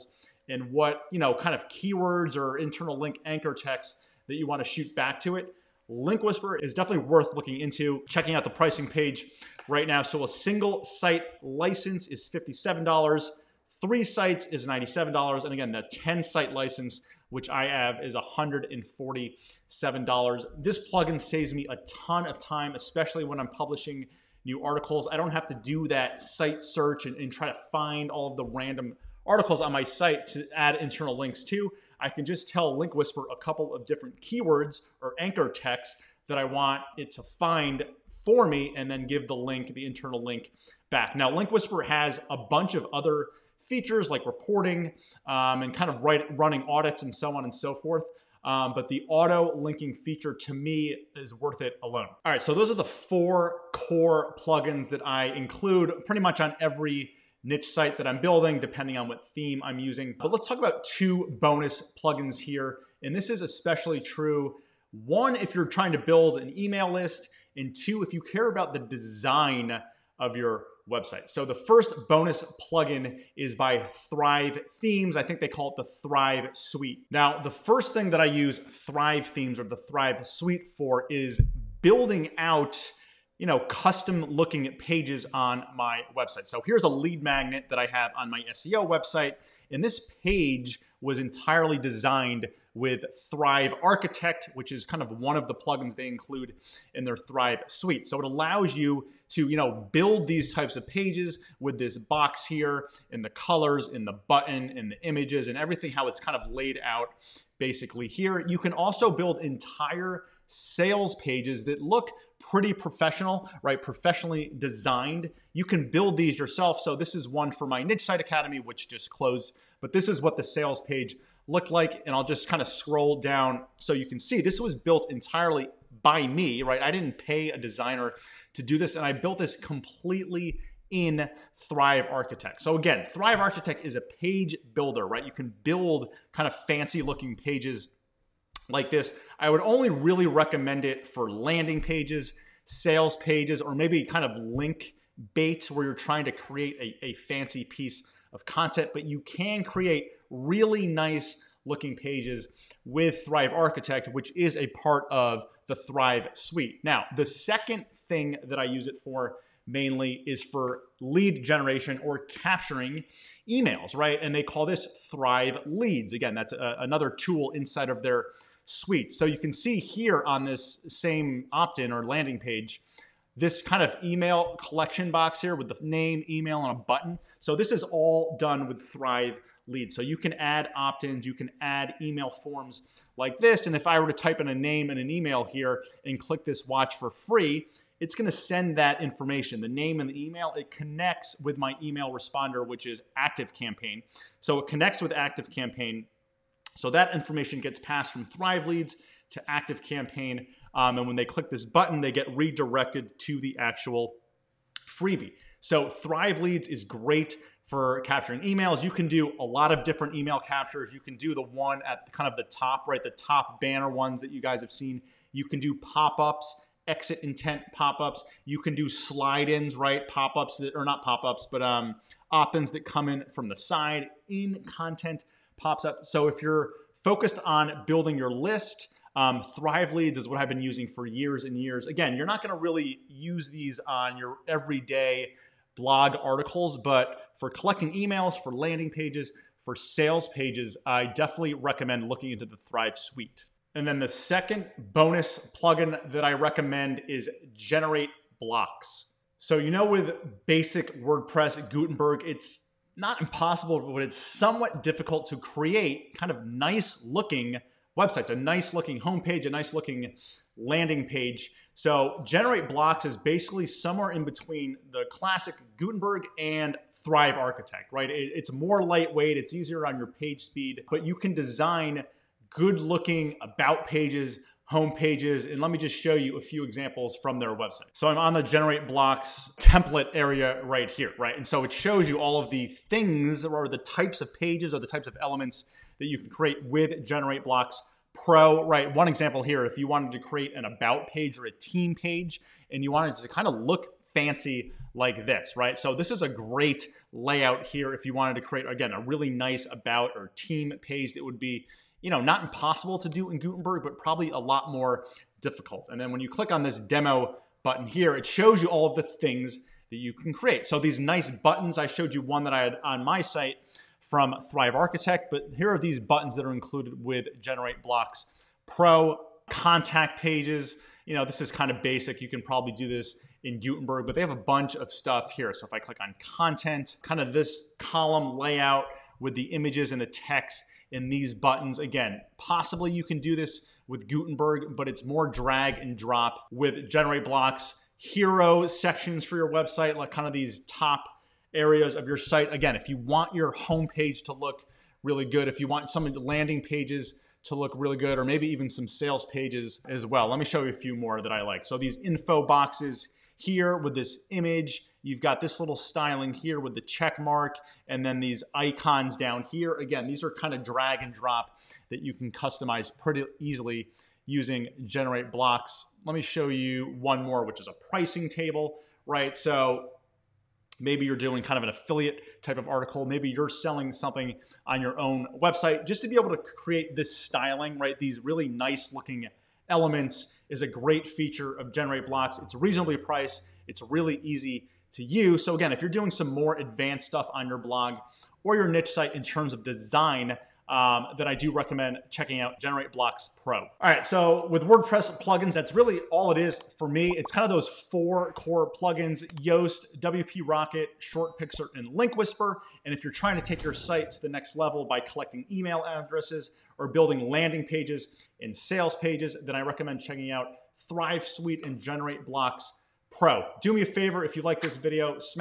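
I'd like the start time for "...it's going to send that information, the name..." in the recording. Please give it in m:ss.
3:07.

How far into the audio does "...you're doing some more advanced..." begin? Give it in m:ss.
6:25.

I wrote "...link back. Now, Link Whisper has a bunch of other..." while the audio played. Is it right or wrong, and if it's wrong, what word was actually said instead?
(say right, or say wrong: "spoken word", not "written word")
right.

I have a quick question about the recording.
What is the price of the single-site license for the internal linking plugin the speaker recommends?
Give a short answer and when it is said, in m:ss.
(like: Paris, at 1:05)
$57, at 0:12.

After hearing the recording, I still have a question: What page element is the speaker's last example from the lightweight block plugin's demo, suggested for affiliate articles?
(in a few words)
pricing table.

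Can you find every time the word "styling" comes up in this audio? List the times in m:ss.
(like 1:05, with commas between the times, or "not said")
5:55, 6:17.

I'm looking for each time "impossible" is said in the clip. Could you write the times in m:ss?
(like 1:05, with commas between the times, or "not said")
4:13, 5:02.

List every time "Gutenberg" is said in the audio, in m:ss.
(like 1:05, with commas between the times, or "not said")
4:11, 4:25, 5:03, 5:23, 5:34.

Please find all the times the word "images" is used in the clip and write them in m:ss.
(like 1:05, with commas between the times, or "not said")
1:45, 5:29, 5:54.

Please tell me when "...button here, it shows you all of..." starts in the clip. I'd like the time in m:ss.
5:07.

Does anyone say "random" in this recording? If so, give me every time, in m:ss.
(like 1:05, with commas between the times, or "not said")
0:28.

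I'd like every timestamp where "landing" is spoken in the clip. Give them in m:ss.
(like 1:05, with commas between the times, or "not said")
2:21, 2:52, 3:58, 4:20, 5:46, 6:47.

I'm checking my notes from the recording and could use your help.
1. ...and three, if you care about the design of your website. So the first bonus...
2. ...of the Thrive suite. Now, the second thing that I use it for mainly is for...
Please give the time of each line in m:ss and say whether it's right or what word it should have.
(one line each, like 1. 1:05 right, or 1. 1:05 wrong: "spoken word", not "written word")
1. 1:07 wrong: "two", not "three"
2. 2:35 right.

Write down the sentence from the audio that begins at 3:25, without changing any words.
So Thrive Leads is great for capturing emails.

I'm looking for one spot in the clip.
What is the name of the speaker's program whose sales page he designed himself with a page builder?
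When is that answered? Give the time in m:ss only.
1:57.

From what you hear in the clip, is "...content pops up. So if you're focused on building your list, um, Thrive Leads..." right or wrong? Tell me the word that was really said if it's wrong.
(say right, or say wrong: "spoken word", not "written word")
right.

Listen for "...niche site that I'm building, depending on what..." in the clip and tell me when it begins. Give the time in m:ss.
0:57.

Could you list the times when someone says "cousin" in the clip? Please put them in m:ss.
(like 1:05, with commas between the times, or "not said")
not said.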